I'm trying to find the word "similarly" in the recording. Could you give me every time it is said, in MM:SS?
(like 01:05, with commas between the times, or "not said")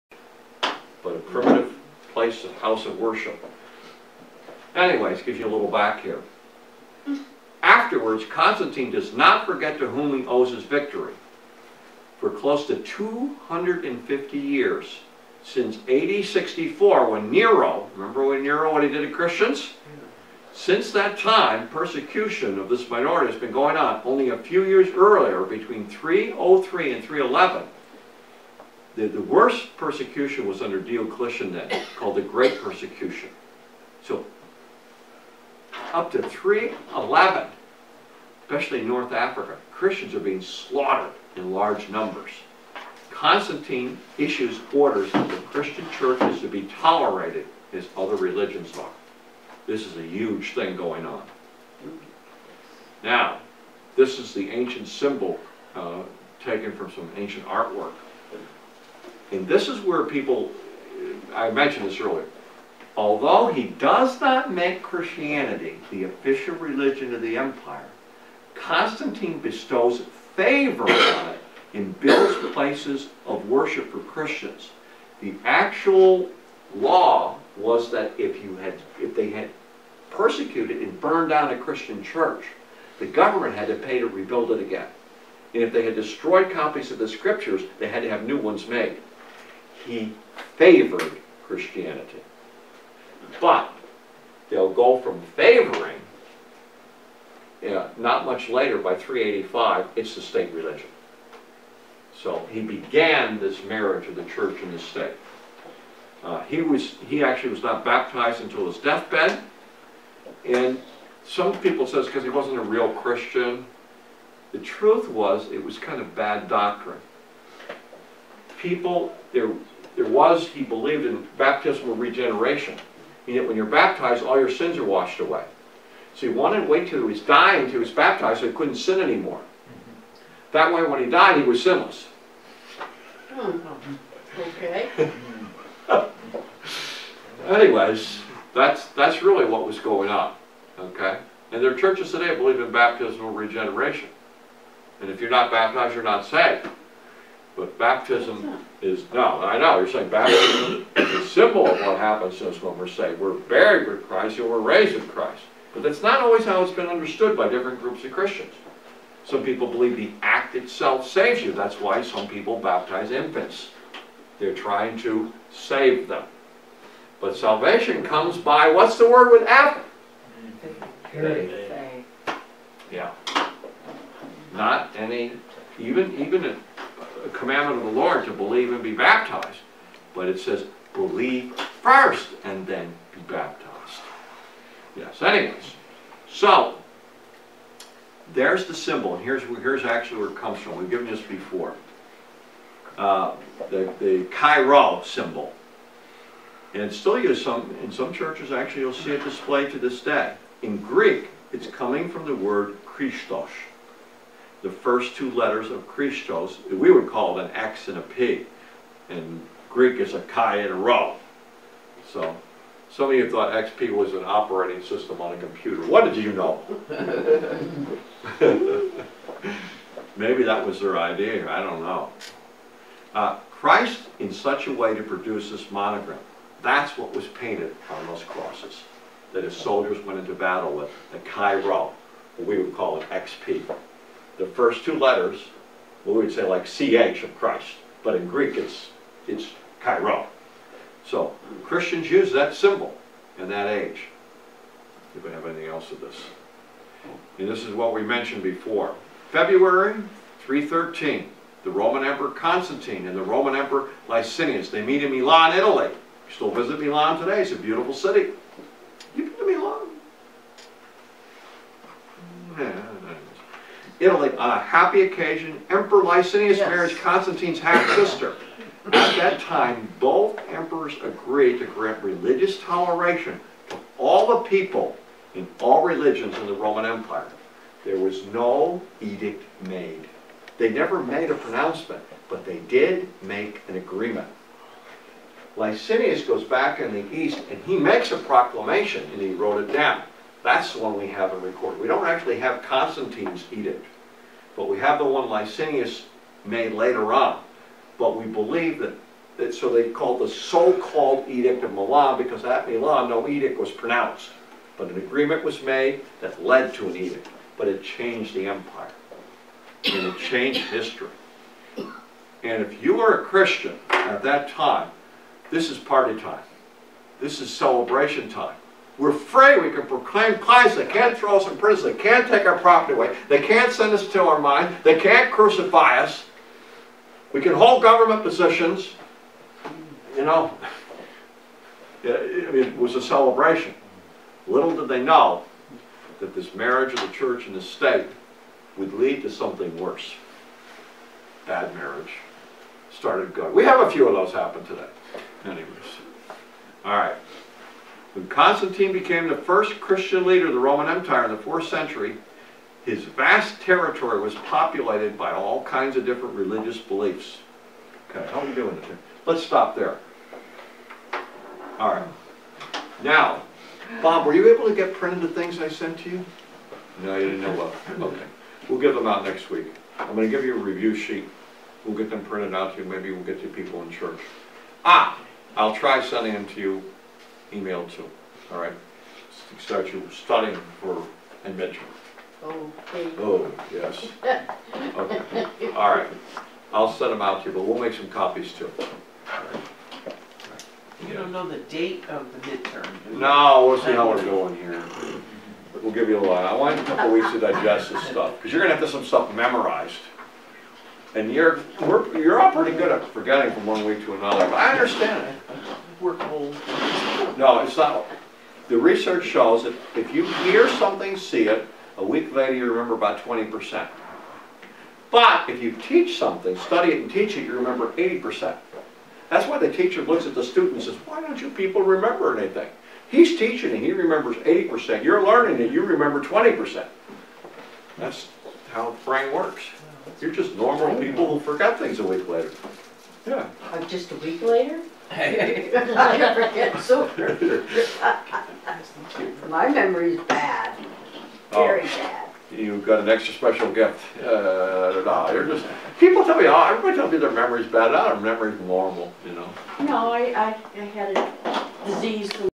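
not said.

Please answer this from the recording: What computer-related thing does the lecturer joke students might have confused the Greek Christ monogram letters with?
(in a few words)
An operating system.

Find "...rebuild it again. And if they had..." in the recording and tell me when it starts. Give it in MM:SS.
01:24.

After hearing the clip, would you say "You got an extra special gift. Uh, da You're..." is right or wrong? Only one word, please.
right.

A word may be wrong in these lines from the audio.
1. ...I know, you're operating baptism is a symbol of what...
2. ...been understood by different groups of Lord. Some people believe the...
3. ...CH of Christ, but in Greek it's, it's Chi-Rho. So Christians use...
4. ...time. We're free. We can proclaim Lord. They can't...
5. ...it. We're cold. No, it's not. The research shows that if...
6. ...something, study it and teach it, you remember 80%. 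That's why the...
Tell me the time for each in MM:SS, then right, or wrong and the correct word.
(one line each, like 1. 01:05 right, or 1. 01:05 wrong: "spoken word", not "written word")
1. 02:29 wrong: "saying", not "operating"
2. 02:36 wrong: "Christians", not "Lord"
3. 03:56 right
4. 05:18 wrong: "Christ", not "Lord"
5. 06:45 right
6. 06:56 right.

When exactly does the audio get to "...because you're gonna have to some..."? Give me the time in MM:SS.
06:38.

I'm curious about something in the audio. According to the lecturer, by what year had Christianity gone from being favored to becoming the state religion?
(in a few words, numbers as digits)
385.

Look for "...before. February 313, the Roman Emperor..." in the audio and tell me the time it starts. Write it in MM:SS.
04:08.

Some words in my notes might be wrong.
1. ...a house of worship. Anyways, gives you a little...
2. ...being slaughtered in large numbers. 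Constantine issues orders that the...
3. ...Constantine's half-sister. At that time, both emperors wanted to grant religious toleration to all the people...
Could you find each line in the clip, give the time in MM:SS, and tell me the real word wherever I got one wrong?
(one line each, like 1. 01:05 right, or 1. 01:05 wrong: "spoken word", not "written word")
1. 00:02 right
2. 00:40 right
3. 04:26 wrong: "agreed", not "wanted".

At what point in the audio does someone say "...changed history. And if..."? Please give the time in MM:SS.
05:10.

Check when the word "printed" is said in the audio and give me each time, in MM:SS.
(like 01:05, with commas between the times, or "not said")
06:04, 06:12.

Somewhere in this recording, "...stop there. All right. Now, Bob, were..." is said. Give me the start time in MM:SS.
05:59.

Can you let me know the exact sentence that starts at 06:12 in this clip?
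Maybe we'll get to people in church.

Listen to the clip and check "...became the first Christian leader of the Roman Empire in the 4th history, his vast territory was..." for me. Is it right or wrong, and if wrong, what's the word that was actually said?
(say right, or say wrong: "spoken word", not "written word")
wrong: "century", not "history".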